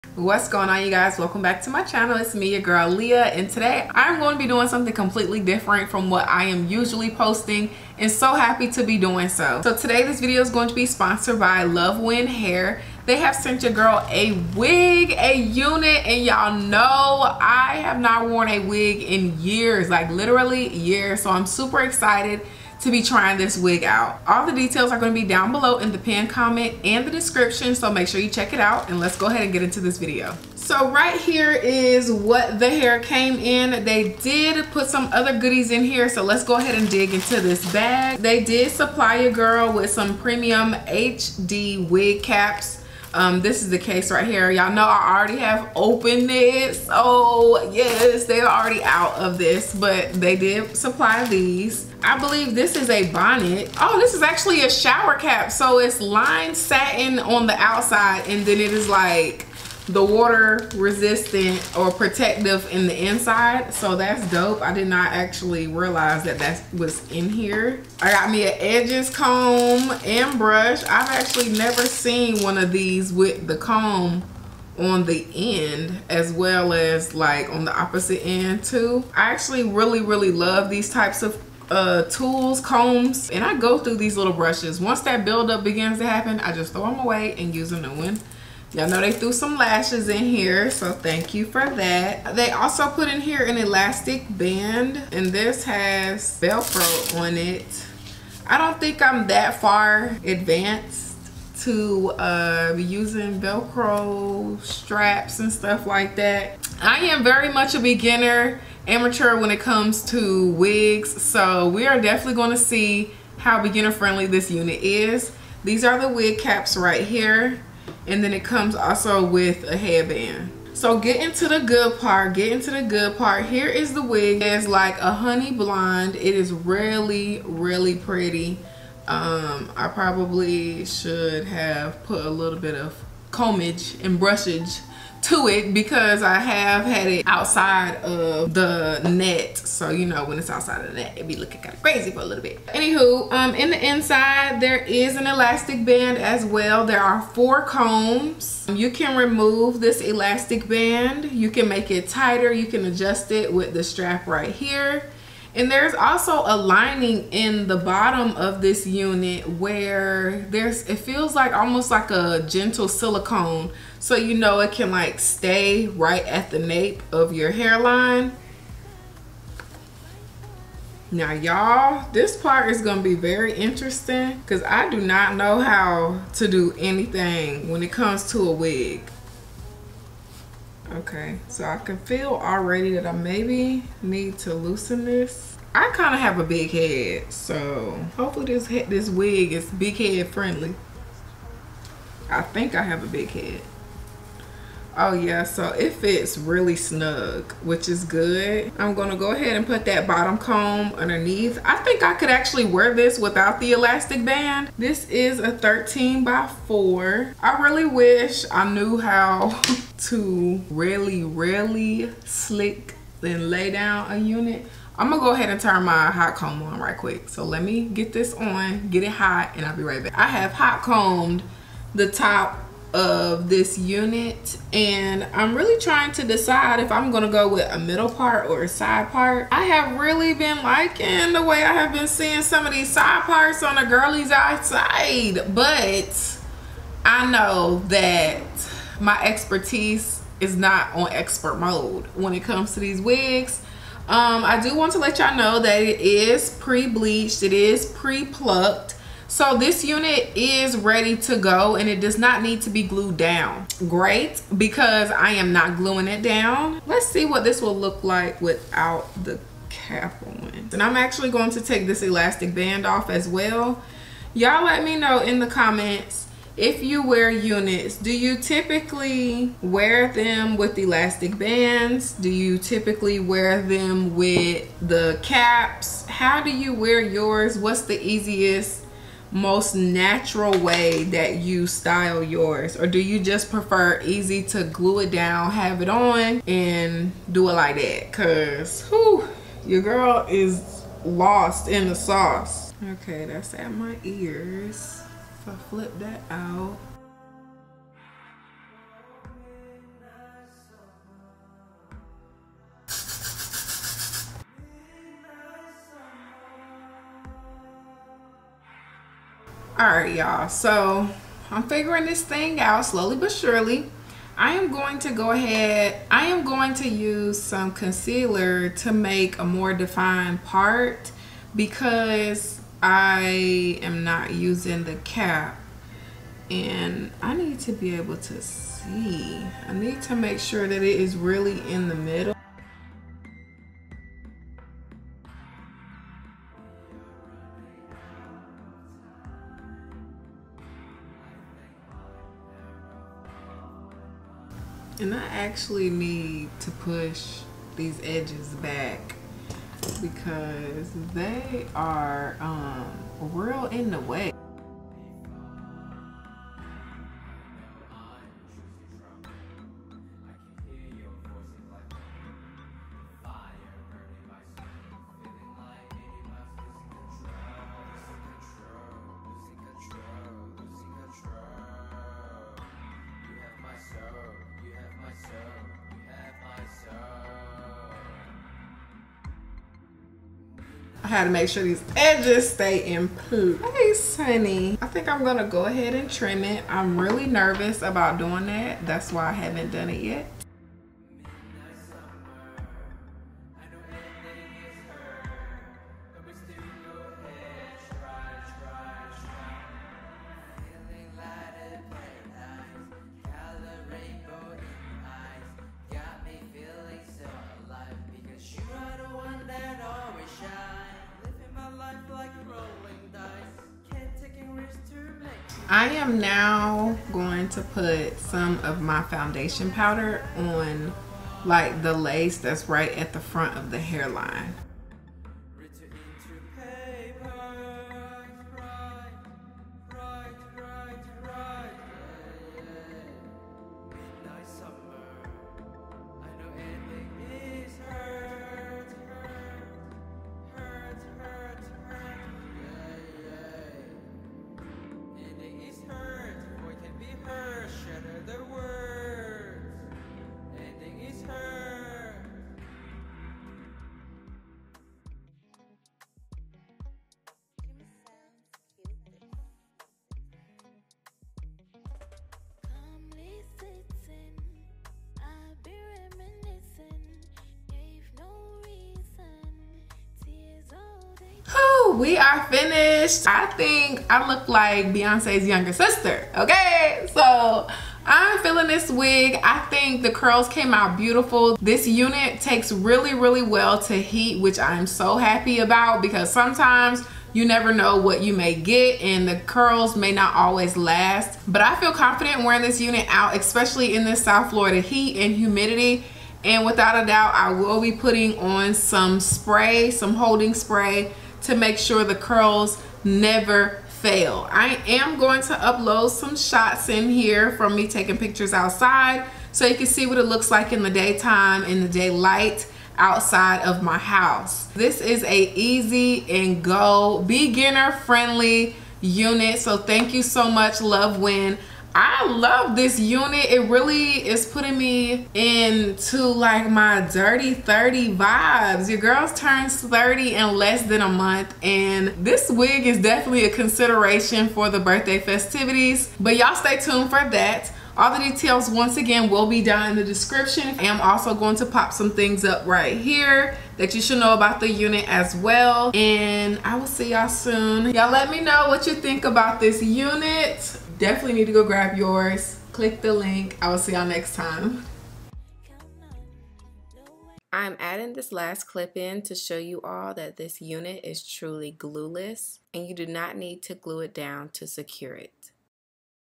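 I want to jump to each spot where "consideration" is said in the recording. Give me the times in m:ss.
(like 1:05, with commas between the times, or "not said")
8:53.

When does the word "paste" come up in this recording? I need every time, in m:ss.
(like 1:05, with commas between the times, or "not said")
not said.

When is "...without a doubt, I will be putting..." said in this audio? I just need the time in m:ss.
8:16.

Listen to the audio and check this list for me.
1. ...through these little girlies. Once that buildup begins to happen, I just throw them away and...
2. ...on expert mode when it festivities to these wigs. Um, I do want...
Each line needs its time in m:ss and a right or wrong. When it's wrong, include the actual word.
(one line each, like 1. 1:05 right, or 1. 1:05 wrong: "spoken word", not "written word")
1. 1:23 wrong: "brushes", not "girlies"
2. 4:00 wrong: "comes", not "festivities".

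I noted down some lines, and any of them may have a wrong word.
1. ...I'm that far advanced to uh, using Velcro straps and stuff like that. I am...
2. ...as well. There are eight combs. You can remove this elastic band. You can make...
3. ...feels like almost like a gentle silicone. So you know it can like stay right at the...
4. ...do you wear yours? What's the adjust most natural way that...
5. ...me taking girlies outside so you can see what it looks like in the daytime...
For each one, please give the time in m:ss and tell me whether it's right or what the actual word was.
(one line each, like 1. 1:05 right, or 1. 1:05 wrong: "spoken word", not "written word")
1. 1:39 right
2. 2:26 wrong: "four", not "eight"
3. 2:40 right
4. 4:36 wrong: "easiest", not "adjust"
5. 8:27 wrong: "pictures", not "girlies".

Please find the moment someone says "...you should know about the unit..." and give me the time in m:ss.
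9:03.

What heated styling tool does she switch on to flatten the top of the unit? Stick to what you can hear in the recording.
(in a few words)
hot comb.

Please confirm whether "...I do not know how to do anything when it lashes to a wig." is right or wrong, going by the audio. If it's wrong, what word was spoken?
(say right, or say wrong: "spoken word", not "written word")
wrong: "comes", not "lashes".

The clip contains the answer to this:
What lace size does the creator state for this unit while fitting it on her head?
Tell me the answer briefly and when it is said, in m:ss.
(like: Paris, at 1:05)
13 by 4, at 3:25.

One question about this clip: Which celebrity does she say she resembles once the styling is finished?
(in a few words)
Beyonce.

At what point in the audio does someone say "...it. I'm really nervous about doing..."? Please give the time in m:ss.
6:26.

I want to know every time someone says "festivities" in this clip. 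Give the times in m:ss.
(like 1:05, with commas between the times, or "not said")
8:55.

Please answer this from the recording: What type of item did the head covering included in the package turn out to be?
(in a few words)
shower cap.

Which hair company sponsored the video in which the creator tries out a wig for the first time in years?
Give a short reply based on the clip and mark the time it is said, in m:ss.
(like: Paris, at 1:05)
Luvwin Hair, at 0:11.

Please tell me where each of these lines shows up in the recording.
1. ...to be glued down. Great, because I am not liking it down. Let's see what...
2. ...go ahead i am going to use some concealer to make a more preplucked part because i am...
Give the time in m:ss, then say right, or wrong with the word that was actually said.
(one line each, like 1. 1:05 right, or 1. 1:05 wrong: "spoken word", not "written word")
1. 4:12 wrong: "gluing", not "liking"
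2. 5:15 wrong: "defined", not "preplucked".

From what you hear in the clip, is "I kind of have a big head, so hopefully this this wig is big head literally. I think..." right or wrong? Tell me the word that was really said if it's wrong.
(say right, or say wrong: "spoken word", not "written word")
wrong: "friendly", not "literally".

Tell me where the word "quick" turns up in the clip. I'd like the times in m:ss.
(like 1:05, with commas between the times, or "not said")
3:36.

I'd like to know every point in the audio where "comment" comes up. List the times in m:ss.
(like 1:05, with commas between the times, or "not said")
0:26, 4:25.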